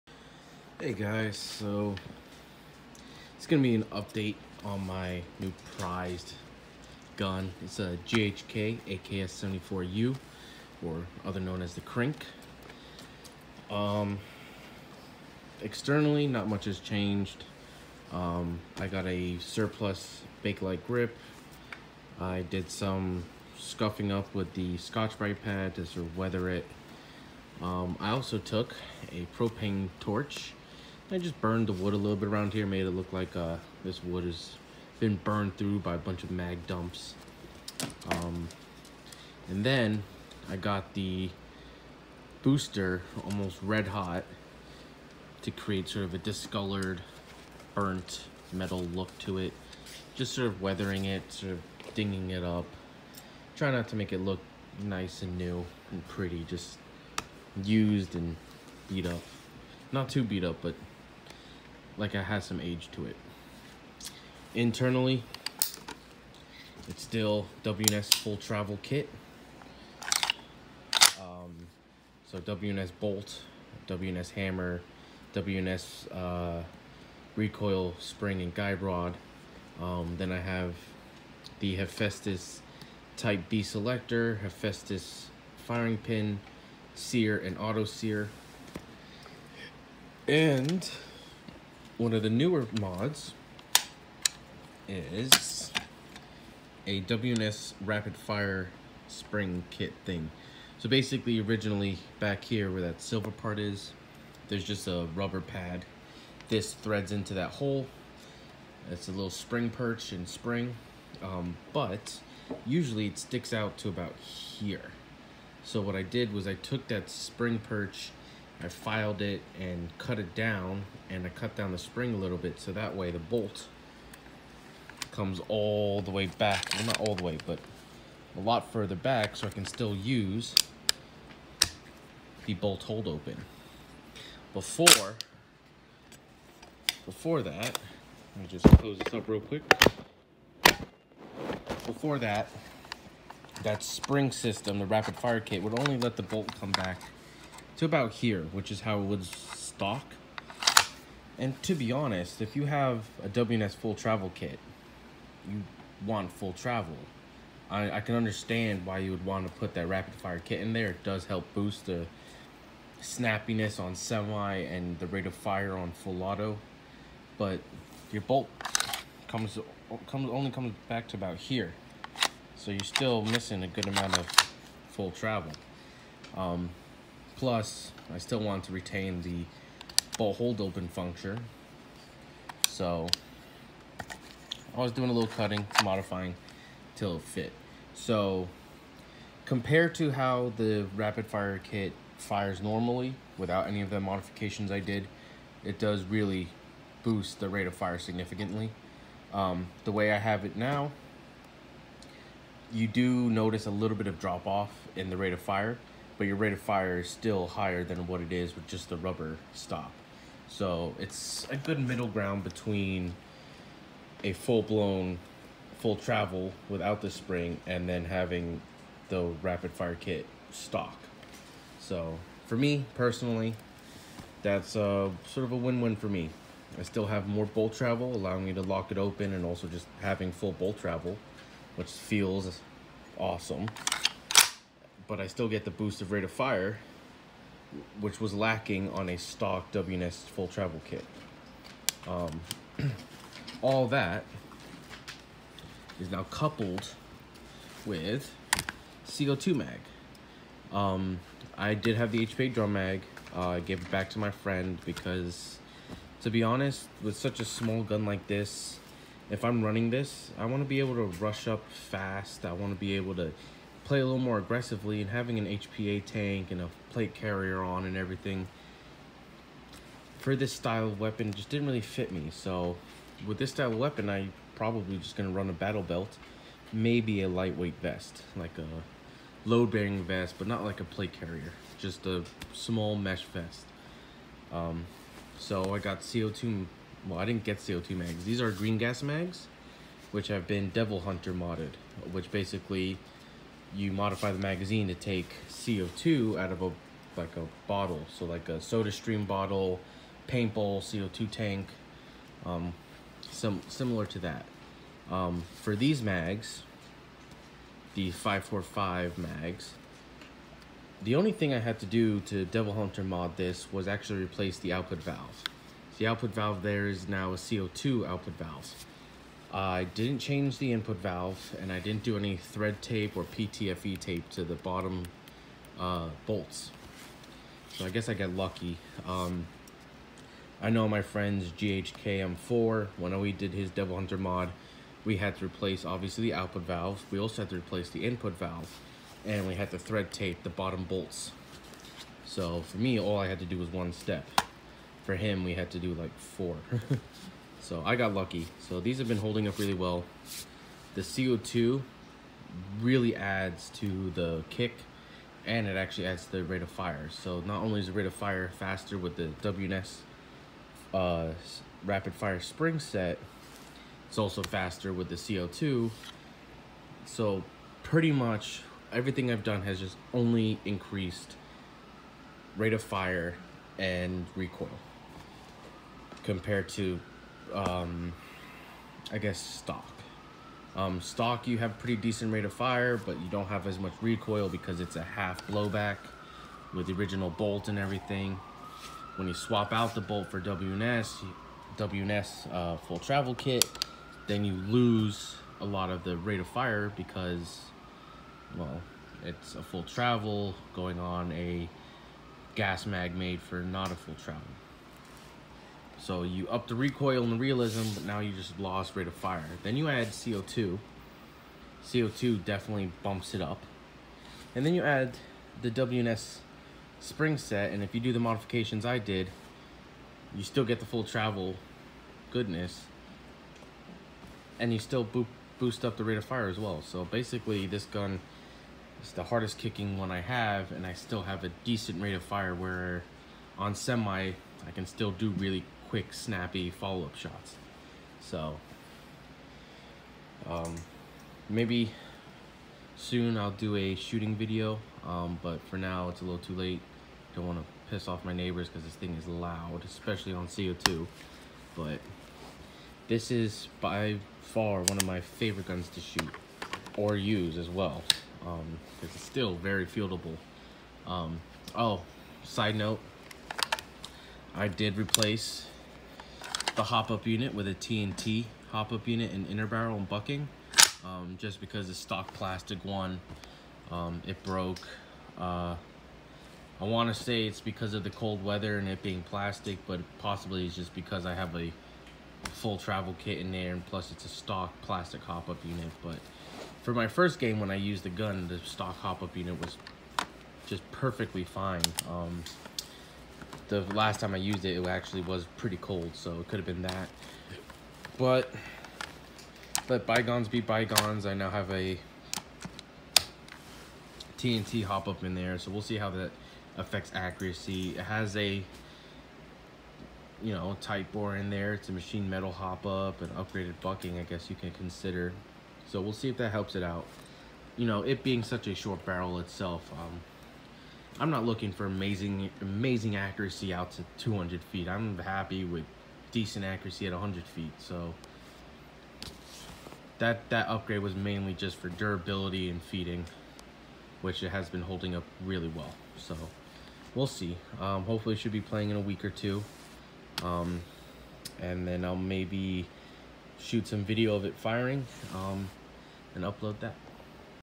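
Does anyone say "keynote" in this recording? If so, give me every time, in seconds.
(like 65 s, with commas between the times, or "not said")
not said.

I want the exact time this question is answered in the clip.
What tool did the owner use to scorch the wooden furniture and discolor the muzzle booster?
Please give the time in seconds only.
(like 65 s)
29 s.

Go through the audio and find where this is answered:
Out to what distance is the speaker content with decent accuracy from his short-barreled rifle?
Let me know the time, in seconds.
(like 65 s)
527 s.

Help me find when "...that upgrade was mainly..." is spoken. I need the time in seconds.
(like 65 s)
530 s.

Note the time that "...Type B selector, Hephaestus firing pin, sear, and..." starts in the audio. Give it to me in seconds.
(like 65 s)
83 s.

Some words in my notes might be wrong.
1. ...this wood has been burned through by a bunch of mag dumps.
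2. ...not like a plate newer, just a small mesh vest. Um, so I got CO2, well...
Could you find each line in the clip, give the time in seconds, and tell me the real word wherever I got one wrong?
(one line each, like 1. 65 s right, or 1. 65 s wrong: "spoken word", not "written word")
1. 33 s right
2. 280 s wrong: "carrier", not "newer".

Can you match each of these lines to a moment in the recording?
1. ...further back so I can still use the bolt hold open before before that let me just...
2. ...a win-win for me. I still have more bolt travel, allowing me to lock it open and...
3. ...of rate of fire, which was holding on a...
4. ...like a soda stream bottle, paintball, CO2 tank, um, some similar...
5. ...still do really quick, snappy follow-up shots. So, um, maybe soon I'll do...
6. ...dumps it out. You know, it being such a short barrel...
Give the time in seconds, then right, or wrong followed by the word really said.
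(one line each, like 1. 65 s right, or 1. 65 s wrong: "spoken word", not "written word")
1. 128 s right
2. 225 s right
3. 236 s wrong: "lacking", not "holding"
4. 298 s right
5. 434 s right
6. 516 s wrong: "helps", not "dumps".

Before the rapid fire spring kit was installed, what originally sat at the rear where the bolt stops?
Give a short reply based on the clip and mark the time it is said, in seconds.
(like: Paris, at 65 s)
a rubber pad, at 105 s.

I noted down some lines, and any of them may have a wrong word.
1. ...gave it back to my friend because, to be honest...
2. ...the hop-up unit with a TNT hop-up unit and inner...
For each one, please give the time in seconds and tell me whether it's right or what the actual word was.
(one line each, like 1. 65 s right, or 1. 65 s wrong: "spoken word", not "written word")
1. 253 s right
2. 466 s right.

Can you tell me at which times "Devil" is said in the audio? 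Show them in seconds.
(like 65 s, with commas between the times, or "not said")
290 s, 312 s, 333 s.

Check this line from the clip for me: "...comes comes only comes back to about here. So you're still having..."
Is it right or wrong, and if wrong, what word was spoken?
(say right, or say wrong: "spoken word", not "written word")
wrong: "missing", not "having".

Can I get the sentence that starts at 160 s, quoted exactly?
It does help boost the snappiness on semi and the rate of fire on full auto.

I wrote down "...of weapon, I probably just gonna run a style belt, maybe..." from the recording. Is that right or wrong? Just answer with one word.
wrong.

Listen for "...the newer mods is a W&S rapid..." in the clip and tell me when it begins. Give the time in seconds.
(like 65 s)
92 s.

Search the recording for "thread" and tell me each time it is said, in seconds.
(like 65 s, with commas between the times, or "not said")
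106 s, 322 s, 339 s.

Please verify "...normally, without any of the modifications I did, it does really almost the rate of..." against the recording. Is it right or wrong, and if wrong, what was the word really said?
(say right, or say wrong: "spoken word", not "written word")
wrong: "boost", not "almost".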